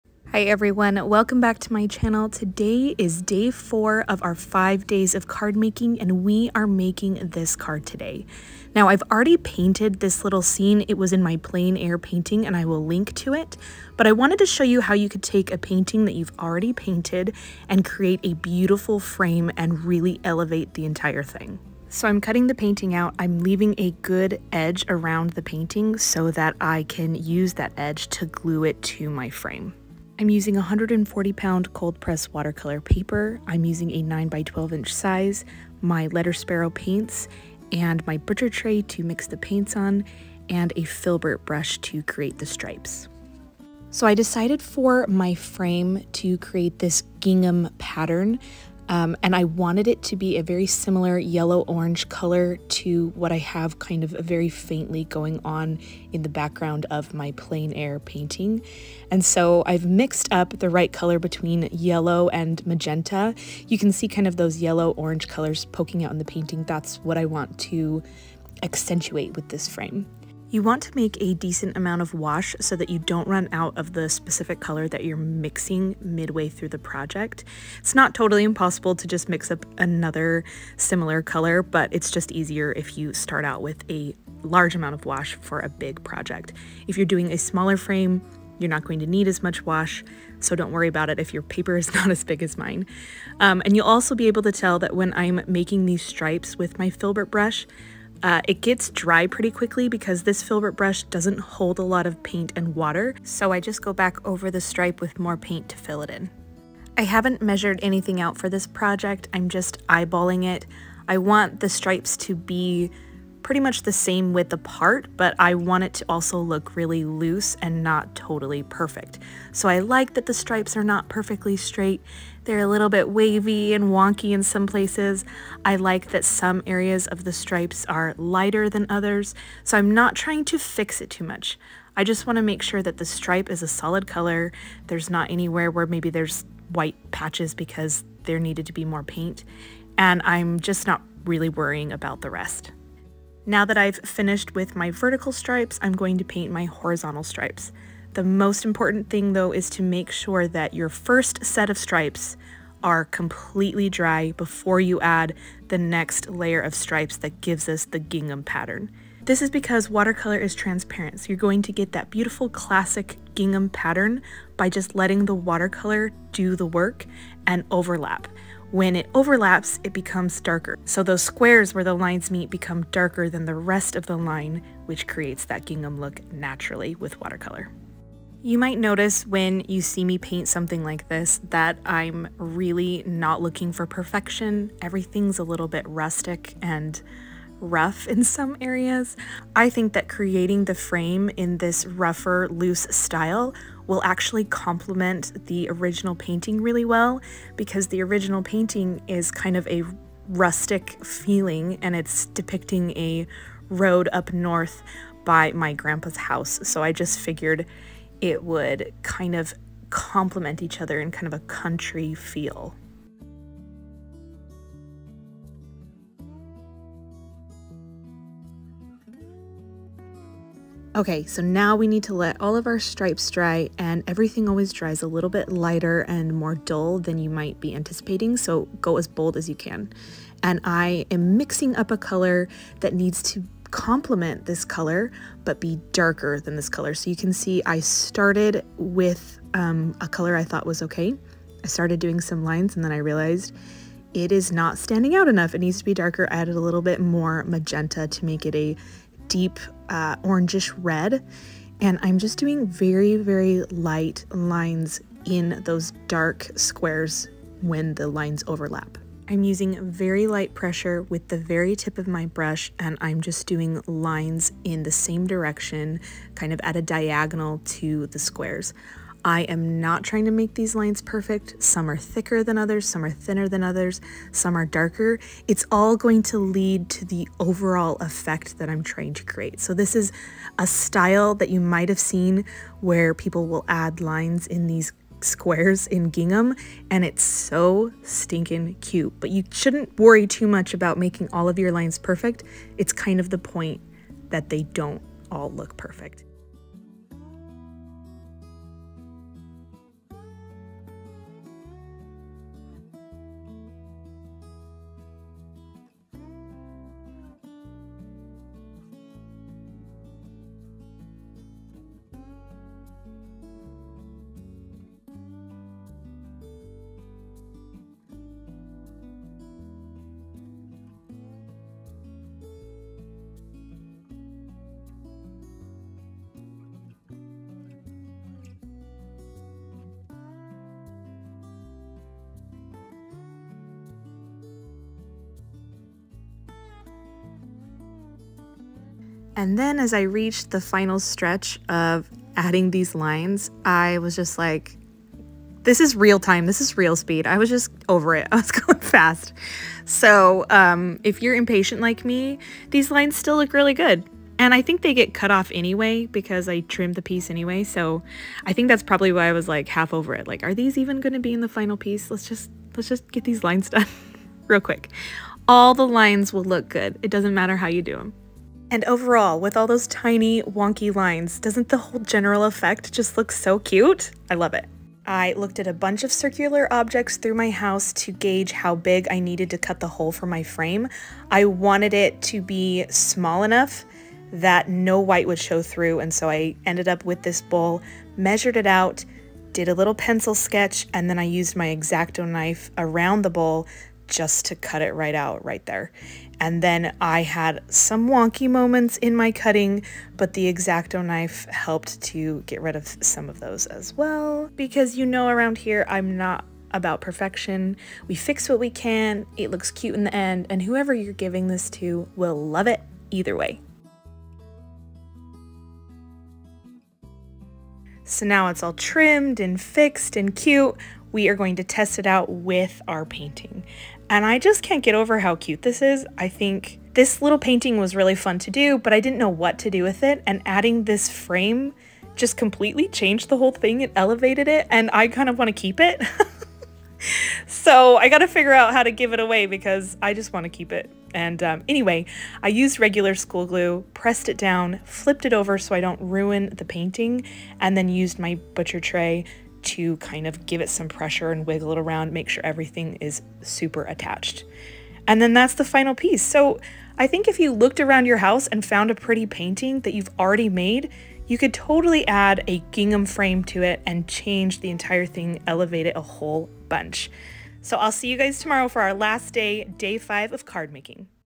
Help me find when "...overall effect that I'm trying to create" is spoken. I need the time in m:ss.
4:37.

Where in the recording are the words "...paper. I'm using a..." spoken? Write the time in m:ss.
0:32.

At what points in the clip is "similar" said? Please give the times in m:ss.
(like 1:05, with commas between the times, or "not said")
0:50, 1:20.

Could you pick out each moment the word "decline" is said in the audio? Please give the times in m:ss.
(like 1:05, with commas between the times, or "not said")
not said.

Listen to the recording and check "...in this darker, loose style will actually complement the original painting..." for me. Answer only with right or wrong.
wrong.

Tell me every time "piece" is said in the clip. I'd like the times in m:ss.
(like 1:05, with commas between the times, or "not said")
5:57, 6:01, 7:35.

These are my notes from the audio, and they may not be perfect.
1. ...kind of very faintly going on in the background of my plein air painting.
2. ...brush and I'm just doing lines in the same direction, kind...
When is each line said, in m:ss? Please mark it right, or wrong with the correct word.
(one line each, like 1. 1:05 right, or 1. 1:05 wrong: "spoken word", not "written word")
1. 0:53 right
2. 4:22 right.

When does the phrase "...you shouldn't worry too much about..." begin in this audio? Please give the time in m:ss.
4:49.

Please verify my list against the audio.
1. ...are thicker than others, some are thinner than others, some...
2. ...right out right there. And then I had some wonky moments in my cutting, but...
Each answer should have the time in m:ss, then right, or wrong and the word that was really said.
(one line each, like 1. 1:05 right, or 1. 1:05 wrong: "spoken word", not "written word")
1. 4:31 right
2. 6:34 right.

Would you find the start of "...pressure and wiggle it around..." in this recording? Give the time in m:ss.
7:30.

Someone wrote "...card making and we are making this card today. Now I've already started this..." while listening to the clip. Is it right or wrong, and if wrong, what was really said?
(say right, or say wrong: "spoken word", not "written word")
wrong: "painted", not "started".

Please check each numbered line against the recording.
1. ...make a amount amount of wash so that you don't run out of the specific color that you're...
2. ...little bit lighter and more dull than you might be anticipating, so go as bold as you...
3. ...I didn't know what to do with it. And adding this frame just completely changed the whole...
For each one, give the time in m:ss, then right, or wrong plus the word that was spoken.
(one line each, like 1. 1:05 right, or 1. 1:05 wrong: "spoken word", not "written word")
1. 1:10 wrong: "decent", not "amount"
2. 3:45 right
3. 7:08 right.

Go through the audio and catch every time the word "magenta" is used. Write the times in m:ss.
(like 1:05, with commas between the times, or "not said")
1:02, 4:07.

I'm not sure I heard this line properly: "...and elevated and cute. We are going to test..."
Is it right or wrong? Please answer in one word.
wrong.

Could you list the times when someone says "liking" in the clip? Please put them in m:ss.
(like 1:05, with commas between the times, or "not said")
not said.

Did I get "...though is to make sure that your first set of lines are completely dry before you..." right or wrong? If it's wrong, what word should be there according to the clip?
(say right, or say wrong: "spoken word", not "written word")
wrong: "stripes", not "lines".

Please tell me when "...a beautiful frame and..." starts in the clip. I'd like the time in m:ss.
0:18.